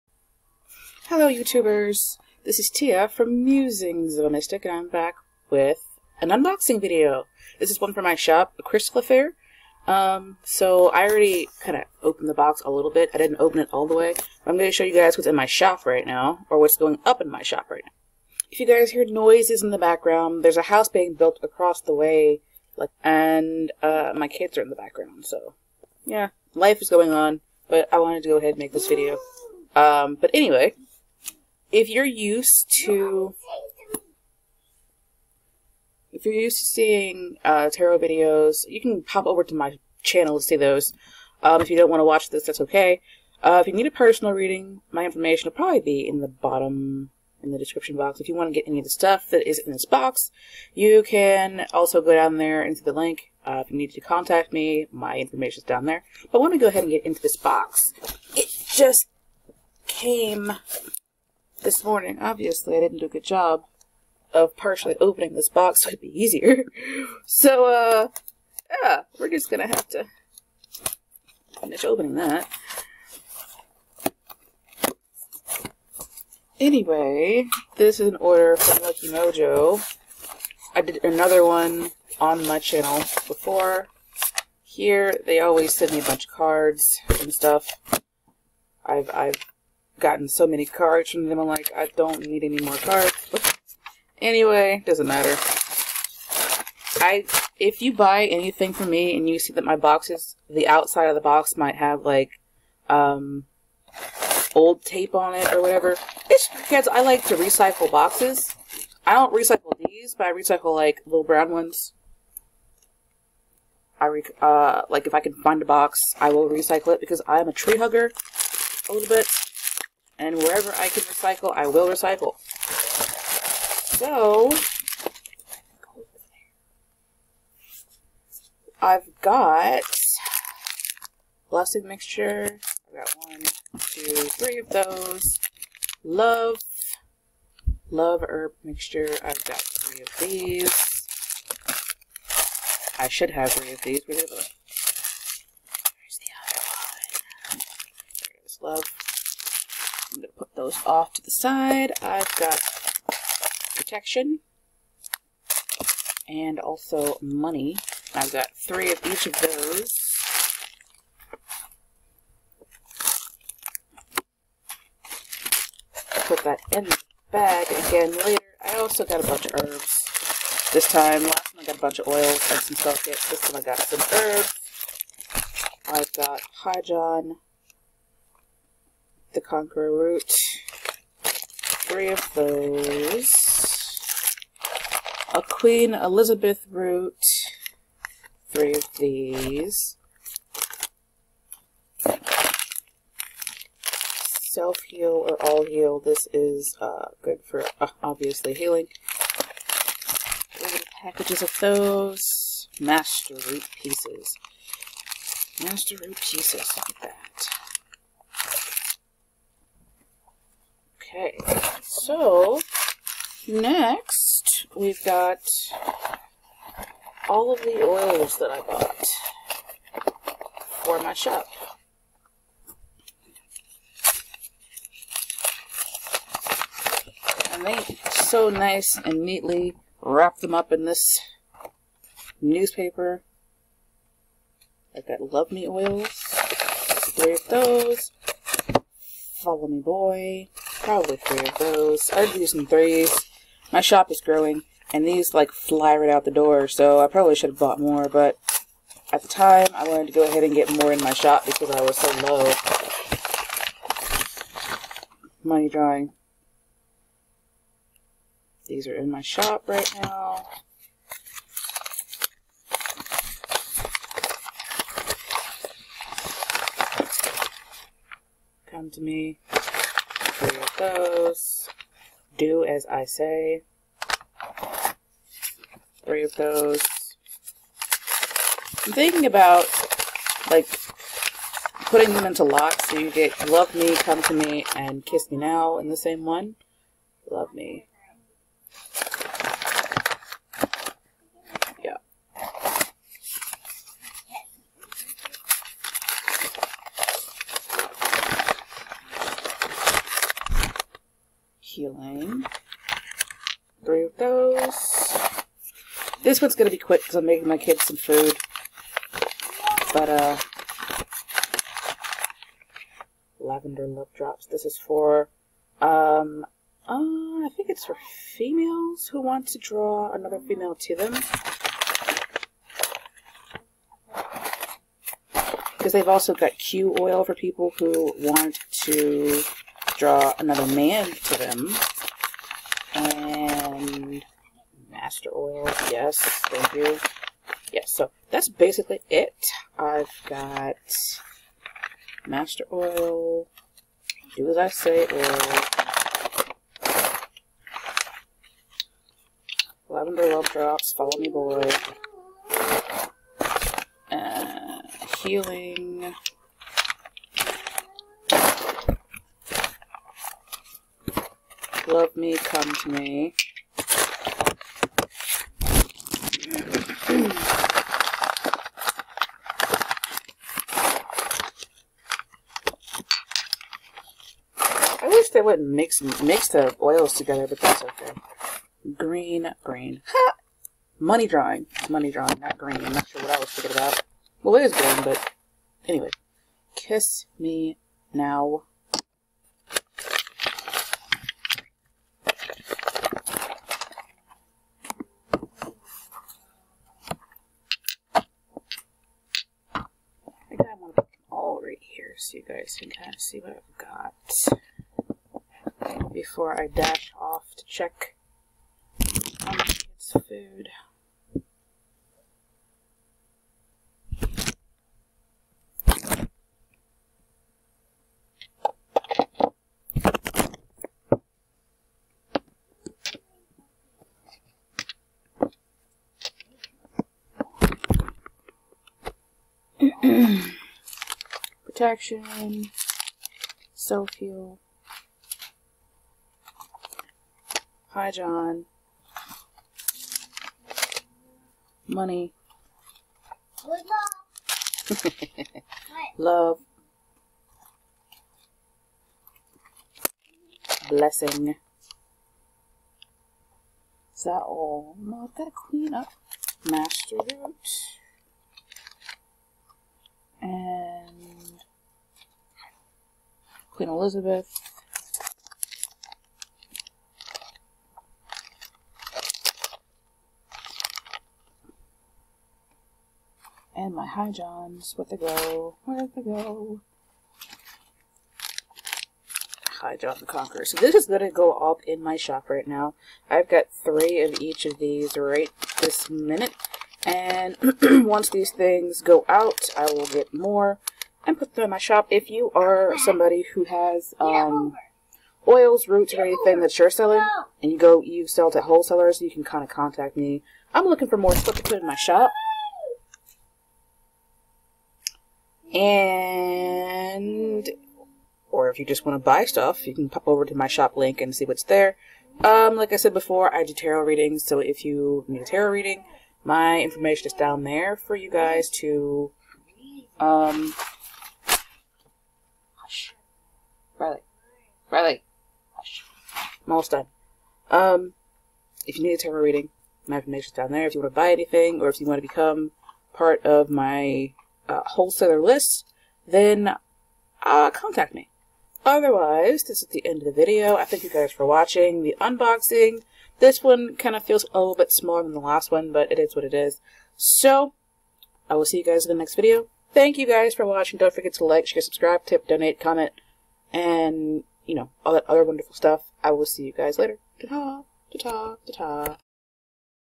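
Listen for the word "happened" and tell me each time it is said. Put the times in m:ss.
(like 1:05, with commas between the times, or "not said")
not said.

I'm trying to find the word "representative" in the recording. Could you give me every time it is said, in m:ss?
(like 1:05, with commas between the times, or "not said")
not said.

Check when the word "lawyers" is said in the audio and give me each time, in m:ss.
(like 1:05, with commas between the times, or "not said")
not said.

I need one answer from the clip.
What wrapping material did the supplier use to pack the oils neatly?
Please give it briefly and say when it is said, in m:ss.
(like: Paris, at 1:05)
Newspaper, at 3:52.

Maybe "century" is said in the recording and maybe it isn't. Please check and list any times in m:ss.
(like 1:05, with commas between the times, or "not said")
not said.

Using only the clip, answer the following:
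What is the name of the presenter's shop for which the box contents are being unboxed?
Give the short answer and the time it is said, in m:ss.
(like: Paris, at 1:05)
A Crystal Affair, at 0:08.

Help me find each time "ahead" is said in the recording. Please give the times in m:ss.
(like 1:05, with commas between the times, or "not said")
0:28, 0:56, 4:10.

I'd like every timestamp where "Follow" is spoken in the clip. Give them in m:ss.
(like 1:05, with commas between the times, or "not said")
3:59, 5:50.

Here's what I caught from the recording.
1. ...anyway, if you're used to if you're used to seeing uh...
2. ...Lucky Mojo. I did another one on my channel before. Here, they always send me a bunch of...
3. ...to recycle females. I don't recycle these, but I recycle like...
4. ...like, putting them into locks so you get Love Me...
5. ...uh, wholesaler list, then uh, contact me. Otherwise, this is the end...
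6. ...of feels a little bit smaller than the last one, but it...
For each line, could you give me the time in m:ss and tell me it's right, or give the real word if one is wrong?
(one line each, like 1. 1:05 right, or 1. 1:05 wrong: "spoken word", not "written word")
1. 0:30 right
2. 1:18 right
3. 1:47 wrong: "boxes", not "females"
4. 4:40 right
5. 8:54 right
6. 9:04 right.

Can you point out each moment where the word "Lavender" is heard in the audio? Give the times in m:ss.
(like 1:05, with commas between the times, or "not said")
5:13, 5:49.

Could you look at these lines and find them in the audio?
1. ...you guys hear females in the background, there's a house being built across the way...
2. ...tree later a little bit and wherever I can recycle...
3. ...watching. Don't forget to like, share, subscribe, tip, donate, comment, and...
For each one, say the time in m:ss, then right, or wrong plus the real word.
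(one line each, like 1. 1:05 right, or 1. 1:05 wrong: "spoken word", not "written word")
1. 0:18 wrong: "noises", not "females"
2. 1:57 wrong: "hugger", not "later"
3. 9:10 right.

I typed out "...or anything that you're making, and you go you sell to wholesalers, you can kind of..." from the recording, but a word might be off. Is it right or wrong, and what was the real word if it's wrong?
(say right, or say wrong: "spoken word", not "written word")
wrong: "selling", not "making".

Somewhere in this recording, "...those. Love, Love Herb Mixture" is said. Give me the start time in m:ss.
2:14.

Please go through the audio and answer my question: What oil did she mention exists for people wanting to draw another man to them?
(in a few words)
Q oil.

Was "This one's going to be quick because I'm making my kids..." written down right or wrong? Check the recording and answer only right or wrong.
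right.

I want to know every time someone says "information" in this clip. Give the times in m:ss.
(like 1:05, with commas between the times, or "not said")
0:45, 0:55, 8:36, 8:50.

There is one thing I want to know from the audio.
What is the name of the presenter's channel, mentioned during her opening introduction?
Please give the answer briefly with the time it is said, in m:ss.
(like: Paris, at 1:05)
Musings of a Mystic, at 0:03.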